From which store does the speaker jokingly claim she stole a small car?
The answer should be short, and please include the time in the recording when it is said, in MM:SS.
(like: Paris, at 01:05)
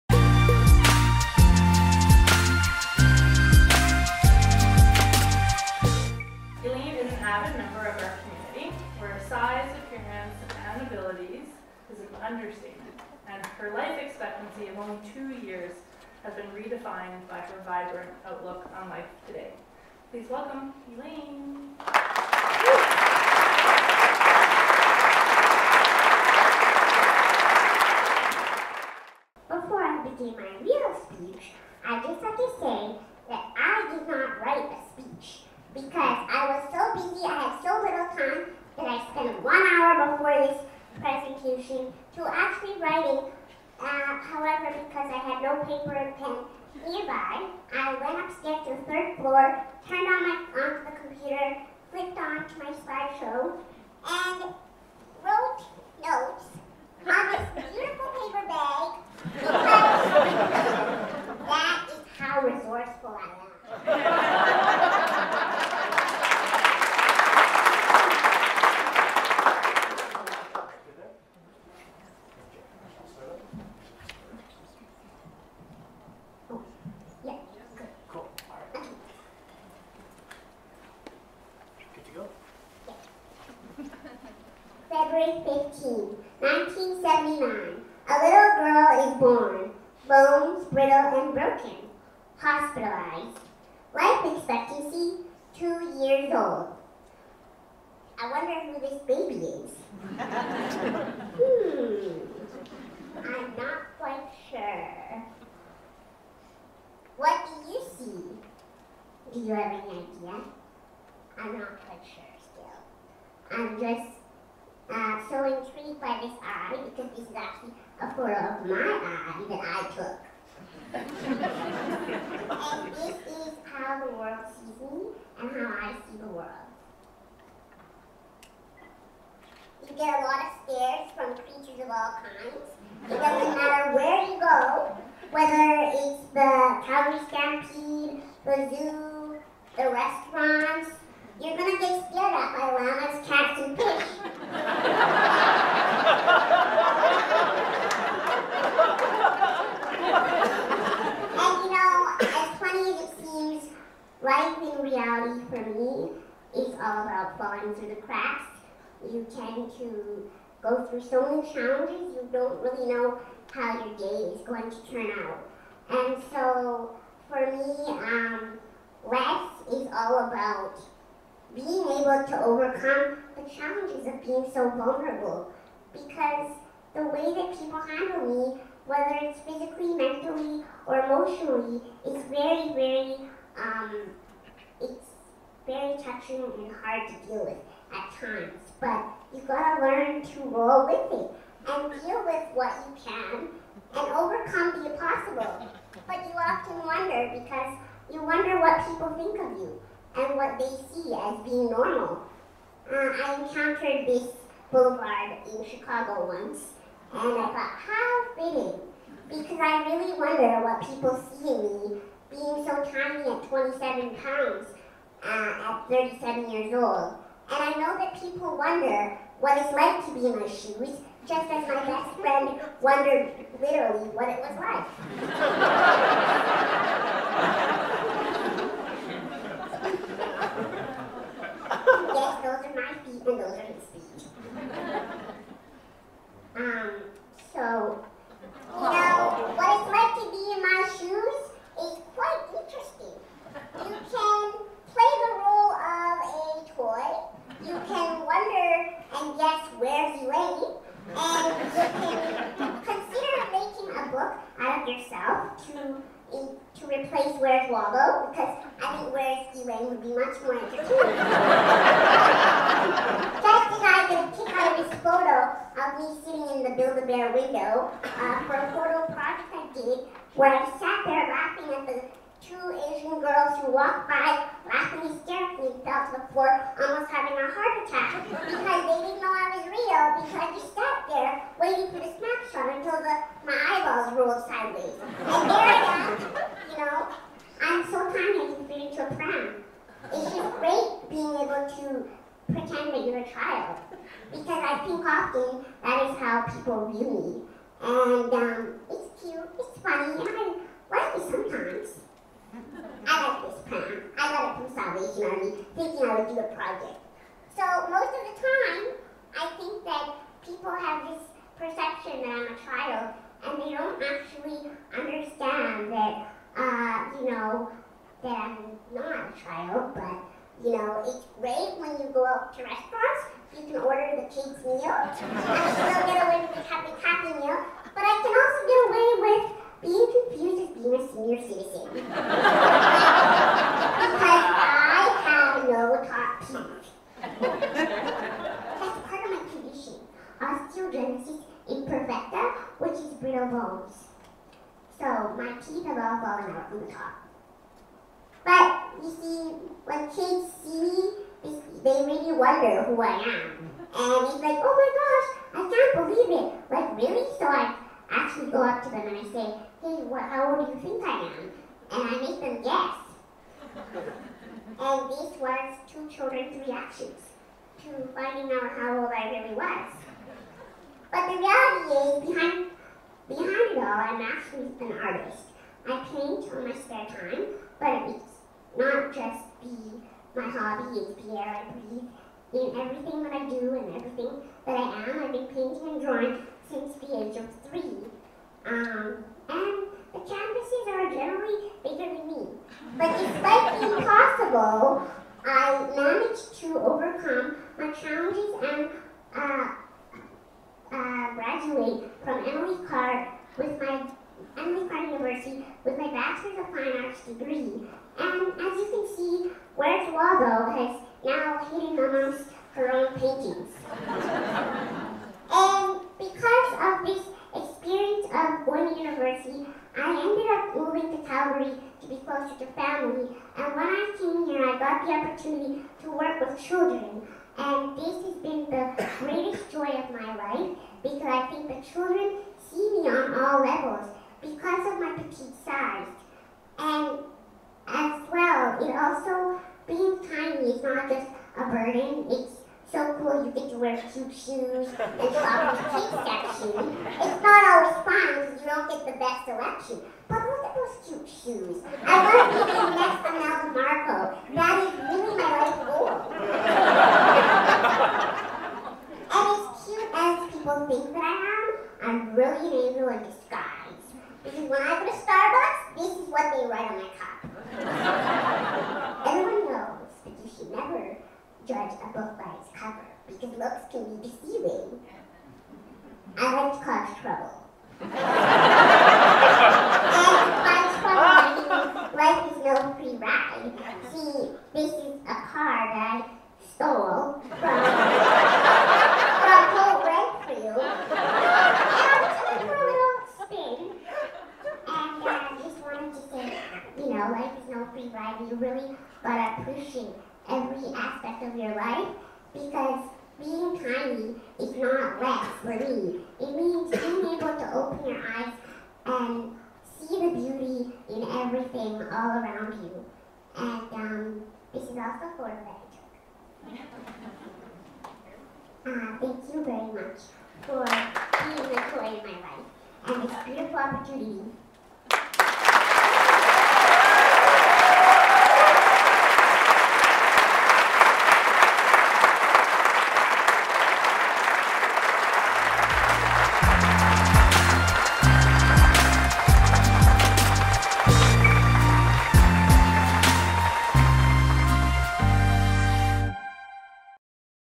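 Holt Renfrew, at 08:09.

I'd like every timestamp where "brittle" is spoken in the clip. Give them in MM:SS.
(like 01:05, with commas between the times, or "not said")
01:30, 05:43.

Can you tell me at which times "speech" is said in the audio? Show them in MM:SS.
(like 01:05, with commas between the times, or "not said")
00:31, 03:53.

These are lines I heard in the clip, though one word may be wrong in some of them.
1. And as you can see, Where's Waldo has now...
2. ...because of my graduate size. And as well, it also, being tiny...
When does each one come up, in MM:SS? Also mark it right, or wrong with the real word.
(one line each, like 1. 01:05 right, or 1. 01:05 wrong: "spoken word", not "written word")
1. 06:48 right
2. 07:14 wrong: "petite", not "graduate".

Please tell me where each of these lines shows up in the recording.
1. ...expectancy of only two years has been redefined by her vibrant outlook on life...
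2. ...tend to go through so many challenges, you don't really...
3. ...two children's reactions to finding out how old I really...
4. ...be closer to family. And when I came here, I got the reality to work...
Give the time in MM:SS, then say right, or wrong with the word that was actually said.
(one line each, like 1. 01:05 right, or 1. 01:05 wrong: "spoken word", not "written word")
1. 00:14 right
2. 02:39 right
3. 06:05 right
4. 07:02 wrong: "opportunity", not "reality".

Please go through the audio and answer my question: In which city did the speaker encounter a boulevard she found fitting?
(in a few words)
Chicago.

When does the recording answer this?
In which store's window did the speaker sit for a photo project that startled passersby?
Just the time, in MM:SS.
04:26.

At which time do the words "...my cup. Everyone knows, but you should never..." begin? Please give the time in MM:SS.
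07:46.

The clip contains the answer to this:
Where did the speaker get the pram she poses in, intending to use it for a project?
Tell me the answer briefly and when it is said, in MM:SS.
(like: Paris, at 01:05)
Salvation Army, at 05:04.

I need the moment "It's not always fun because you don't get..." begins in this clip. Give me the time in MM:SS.
07:27.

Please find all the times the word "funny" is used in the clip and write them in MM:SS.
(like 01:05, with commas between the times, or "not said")
02:32, 04:59.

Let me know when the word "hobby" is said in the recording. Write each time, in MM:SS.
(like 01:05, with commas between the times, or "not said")
06:20.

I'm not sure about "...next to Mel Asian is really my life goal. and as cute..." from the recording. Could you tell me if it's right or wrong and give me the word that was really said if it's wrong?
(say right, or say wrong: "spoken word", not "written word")
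wrong: "That", not "Asian".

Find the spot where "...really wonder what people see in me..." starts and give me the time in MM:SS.
03:29.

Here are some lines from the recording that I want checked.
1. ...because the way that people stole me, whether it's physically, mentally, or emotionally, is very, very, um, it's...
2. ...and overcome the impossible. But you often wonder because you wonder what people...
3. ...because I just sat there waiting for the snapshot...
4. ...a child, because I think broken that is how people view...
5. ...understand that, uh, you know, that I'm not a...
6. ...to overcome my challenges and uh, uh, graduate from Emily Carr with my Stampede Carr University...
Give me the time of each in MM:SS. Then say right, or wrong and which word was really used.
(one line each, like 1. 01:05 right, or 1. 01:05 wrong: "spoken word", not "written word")
1. 02:55 wrong: "handle", not "stole"
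2. 03:13 right
3. 04:40 right
4. 04:53 wrong: "often", not "broken"
5. 05:14 right
6. 06:36 wrong: "Emily", not "Stampede".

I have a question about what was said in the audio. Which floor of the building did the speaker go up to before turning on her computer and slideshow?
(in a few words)
Third floor.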